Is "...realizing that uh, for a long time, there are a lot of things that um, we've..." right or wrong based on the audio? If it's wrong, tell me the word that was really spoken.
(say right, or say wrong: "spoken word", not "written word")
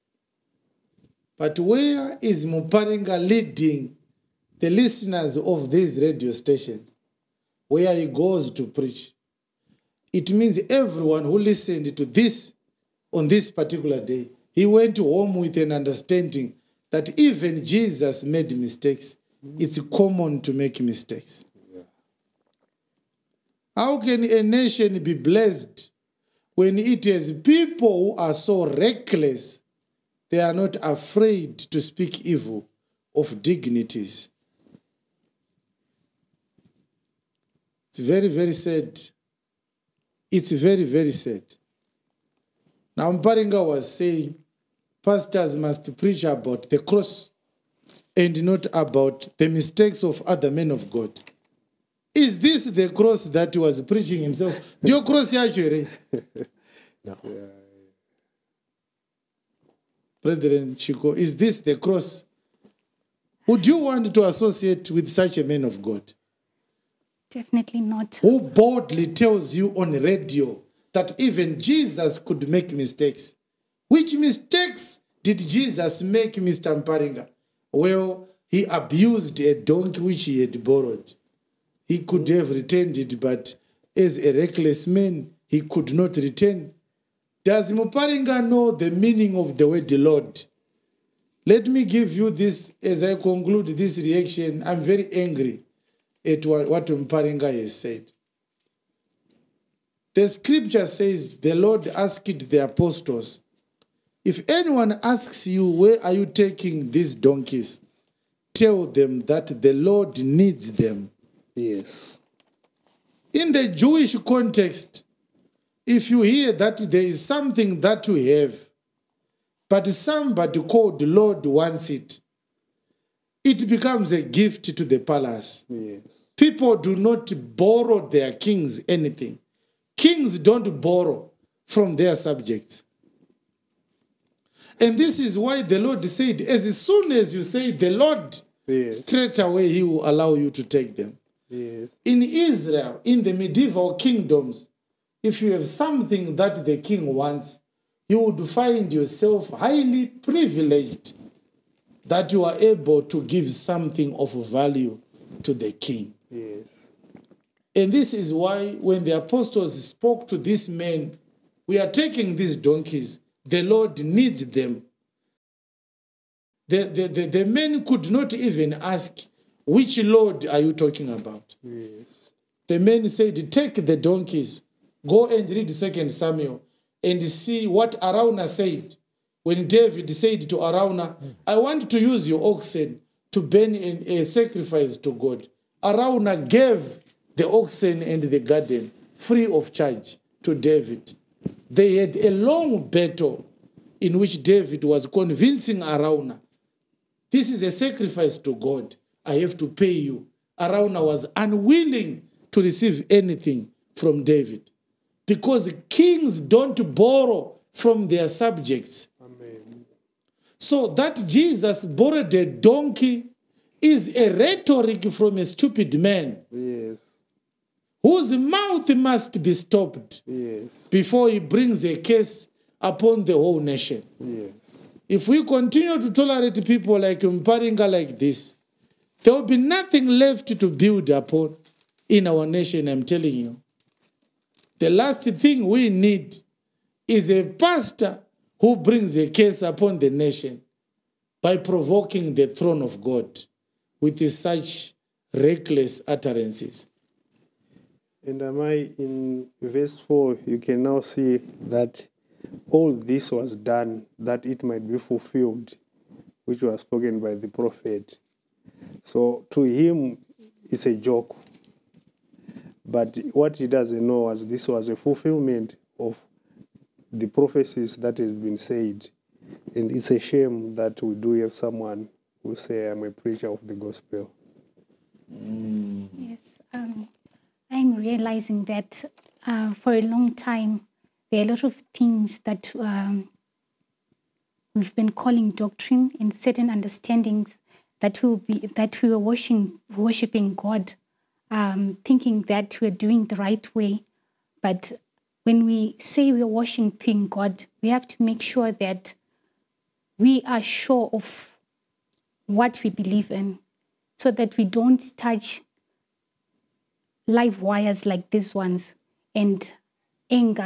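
right.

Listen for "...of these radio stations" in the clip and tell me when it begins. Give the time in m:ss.
0:05.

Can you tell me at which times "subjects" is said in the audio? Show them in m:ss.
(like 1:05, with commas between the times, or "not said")
2:12, 3:28.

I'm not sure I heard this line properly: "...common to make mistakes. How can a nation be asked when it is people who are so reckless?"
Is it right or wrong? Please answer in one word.
wrong.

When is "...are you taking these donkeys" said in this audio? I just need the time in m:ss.
1:46.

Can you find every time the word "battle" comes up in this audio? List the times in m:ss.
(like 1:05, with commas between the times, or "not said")
3:12.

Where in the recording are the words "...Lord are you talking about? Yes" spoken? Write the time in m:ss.
2:50.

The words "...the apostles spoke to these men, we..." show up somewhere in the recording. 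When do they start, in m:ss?
2:39.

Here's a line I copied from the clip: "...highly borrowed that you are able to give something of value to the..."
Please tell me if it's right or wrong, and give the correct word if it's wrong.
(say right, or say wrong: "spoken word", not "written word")
wrong: "privileged", not "borrowed".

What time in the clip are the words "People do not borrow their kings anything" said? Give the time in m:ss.
2:06.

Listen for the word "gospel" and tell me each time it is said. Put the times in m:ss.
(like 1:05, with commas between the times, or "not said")
4:33.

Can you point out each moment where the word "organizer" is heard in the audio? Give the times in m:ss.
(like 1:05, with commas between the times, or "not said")
not said.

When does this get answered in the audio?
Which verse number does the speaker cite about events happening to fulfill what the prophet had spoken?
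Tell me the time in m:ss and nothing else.
4:09.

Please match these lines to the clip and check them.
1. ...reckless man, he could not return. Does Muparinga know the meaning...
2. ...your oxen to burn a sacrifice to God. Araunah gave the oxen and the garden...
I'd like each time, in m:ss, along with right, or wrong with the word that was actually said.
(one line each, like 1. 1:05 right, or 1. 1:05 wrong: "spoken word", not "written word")
1. 1:24 right
2. 3:02 right.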